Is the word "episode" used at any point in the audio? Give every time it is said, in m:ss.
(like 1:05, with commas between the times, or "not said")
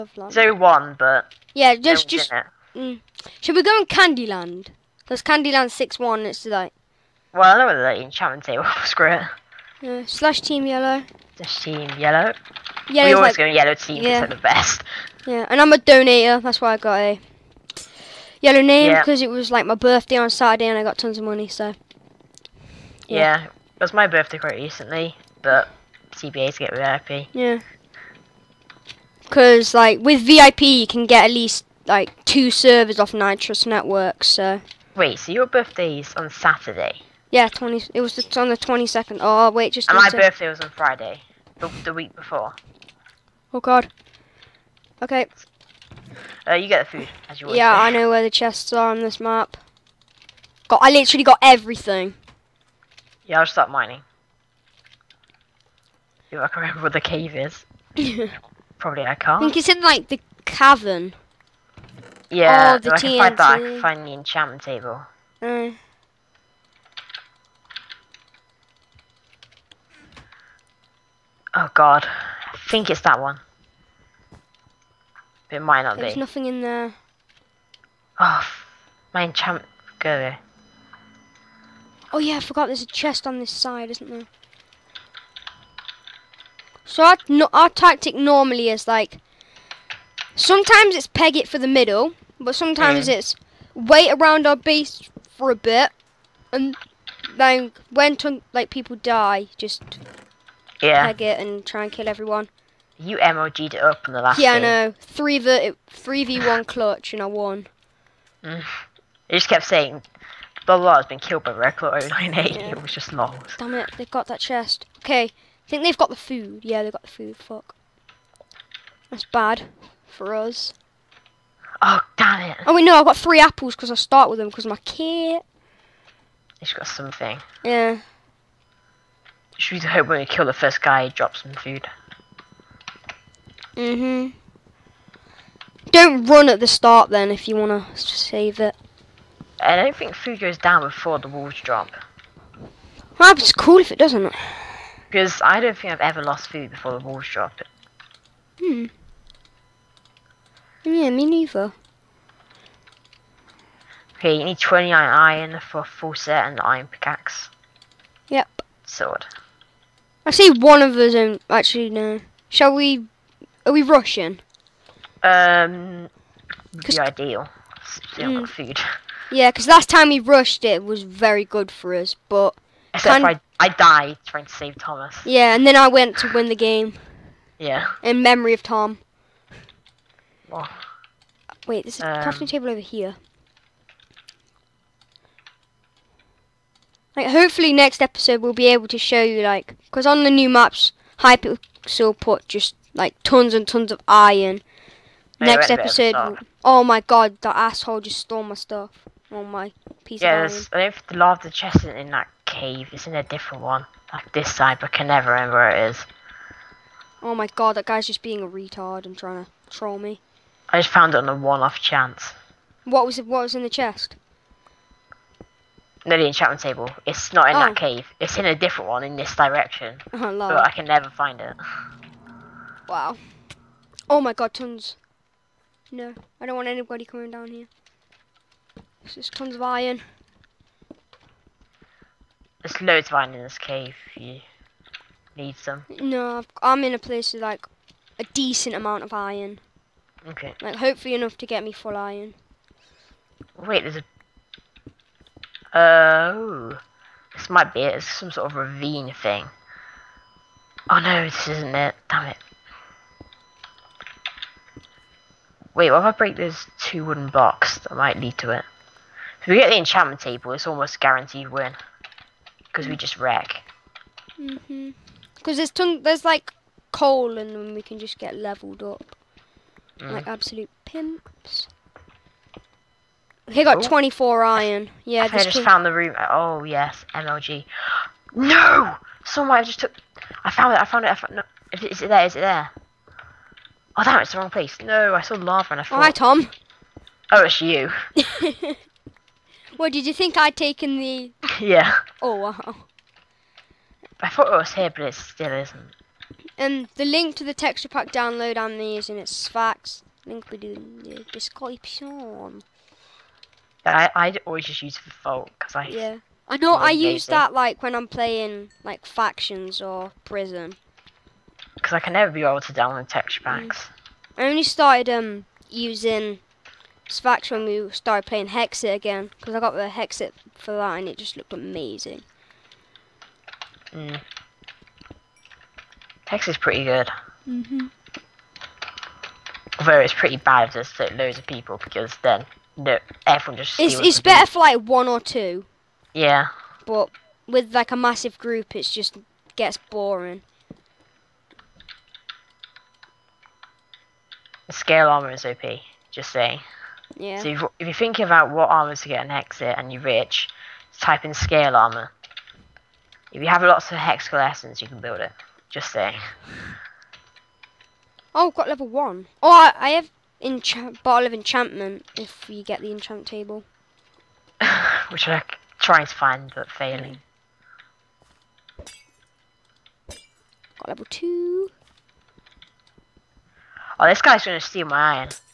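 3:08, 3:15.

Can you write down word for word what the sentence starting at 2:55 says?
Yeah, and then I went to win the game.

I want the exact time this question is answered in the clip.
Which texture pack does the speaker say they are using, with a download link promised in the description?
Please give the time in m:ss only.
4:59.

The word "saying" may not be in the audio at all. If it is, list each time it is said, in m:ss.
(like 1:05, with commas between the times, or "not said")
1:49, 5:46, 5:55.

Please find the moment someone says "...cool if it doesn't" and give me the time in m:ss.
2:23.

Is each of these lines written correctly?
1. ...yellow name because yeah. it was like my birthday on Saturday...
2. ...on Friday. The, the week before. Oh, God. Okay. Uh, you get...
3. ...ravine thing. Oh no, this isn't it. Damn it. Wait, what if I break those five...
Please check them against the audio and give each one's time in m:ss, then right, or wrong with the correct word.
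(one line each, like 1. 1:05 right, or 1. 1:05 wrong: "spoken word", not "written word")
1. 0:18 right
2. 0:40 right
3. 4:08 wrong: "two", not "five".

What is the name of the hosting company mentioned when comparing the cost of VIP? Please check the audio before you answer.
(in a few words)
Nitrous Network.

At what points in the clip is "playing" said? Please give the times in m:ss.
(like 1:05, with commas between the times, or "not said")
5:08, 5:18.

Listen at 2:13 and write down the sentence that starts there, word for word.
Mm hmm Don't run at the start then if you want to save it.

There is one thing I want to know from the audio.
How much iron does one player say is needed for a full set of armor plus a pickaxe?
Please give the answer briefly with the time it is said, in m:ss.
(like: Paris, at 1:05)
29, at 2:34.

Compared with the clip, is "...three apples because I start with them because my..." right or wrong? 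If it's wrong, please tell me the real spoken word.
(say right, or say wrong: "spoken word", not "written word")
right.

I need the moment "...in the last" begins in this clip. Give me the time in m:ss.
1:44.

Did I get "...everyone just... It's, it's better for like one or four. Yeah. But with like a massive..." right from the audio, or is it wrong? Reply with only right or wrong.
wrong.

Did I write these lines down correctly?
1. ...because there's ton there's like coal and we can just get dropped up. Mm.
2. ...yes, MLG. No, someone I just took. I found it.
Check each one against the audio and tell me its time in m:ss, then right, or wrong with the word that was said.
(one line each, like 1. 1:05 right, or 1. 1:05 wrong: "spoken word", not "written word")
1. 4:25 wrong: "leveled", not "dropped"
2. 4:36 right.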